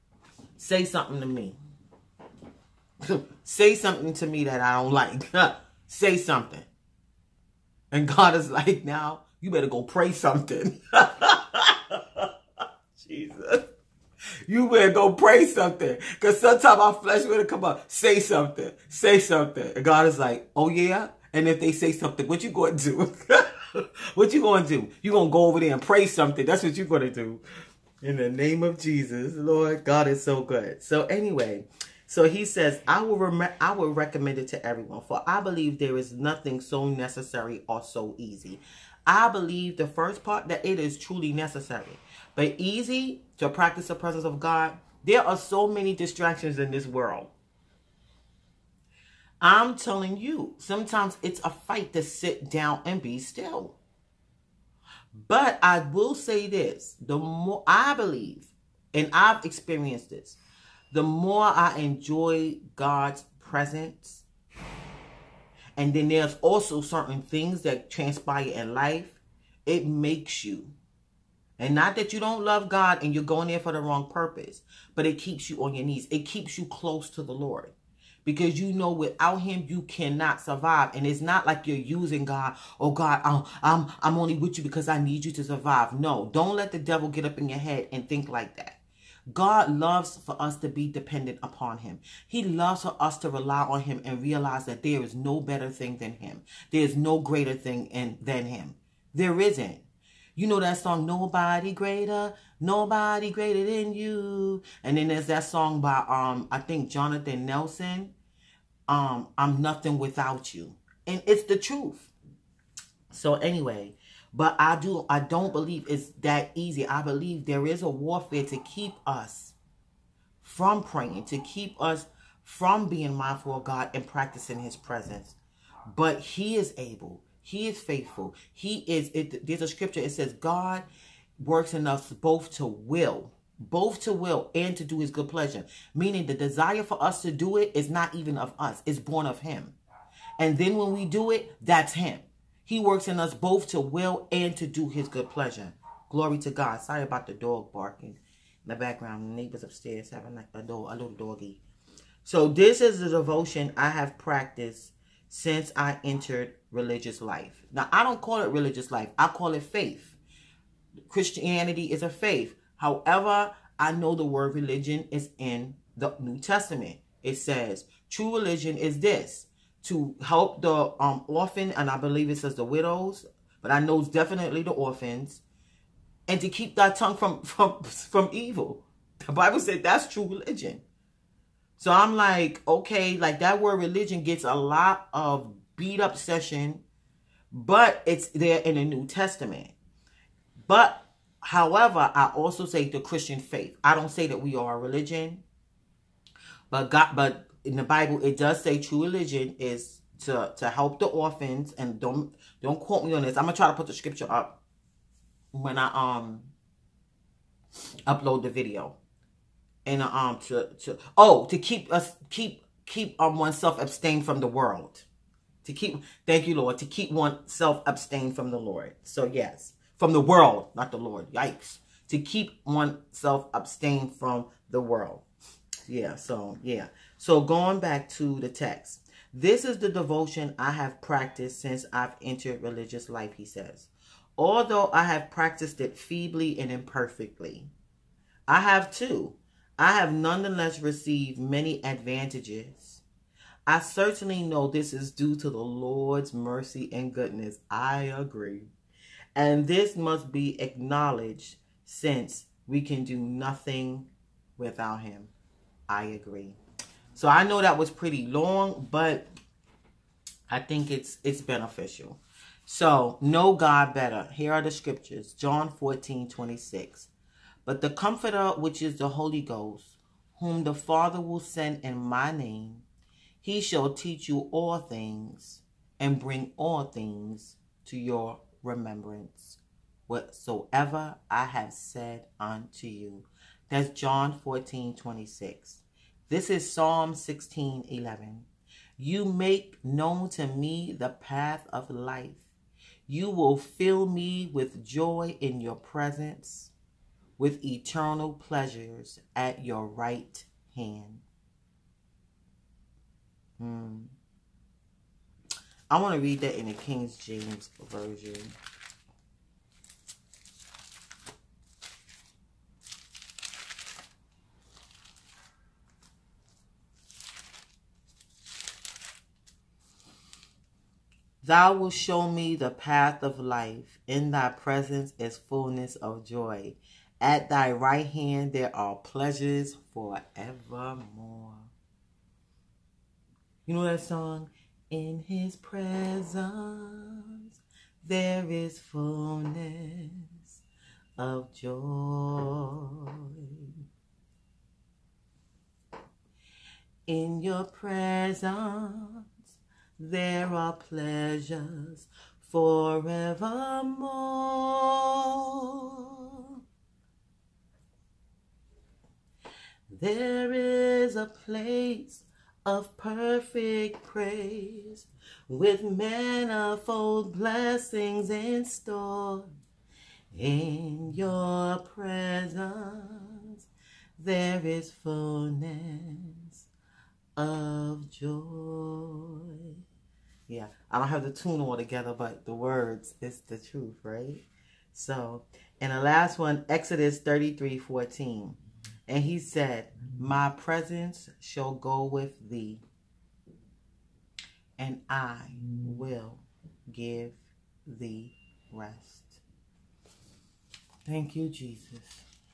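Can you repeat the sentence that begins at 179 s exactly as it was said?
The Bible said that's true religion.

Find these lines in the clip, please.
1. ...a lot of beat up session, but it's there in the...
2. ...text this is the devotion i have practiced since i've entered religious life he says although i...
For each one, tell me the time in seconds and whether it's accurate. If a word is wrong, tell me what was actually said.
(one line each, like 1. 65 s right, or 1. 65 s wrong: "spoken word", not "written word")
1. 184 s right
2. 228 s right.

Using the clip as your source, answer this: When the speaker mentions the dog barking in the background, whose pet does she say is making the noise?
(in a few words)
Neighbors upstairs.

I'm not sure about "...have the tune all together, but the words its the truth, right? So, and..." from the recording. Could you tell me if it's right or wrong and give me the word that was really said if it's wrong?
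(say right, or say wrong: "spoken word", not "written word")
right.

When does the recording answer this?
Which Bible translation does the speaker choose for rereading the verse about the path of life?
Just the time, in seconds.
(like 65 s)
306 s.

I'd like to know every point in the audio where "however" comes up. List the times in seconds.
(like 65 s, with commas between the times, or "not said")
162 s, 191 s.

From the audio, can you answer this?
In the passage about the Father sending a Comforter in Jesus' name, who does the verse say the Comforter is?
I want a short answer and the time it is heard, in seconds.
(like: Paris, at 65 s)
The Holy Ghost, at 268 s.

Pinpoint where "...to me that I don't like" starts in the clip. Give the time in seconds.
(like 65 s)
4 s.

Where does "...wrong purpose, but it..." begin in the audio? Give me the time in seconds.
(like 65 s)
73 s.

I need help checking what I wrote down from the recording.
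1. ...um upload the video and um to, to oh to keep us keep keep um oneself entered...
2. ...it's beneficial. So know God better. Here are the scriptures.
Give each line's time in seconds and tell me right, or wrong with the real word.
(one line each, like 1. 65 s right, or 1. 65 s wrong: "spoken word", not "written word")
1. 205 s wrong: "abstained", not "entered"
2. 261 s right.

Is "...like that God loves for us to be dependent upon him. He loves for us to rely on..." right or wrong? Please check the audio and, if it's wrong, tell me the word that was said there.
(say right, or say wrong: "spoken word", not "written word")
right.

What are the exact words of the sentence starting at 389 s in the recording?
And he said, My presence shall go with thee, and I will give thee rest.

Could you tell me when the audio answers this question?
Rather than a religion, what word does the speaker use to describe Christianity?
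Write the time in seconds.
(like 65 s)
162 s.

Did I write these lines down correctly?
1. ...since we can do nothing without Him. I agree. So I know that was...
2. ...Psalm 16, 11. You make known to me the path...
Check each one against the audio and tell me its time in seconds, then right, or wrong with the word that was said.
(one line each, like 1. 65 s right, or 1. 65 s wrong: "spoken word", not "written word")
1. 251 s right
2. 286 s right.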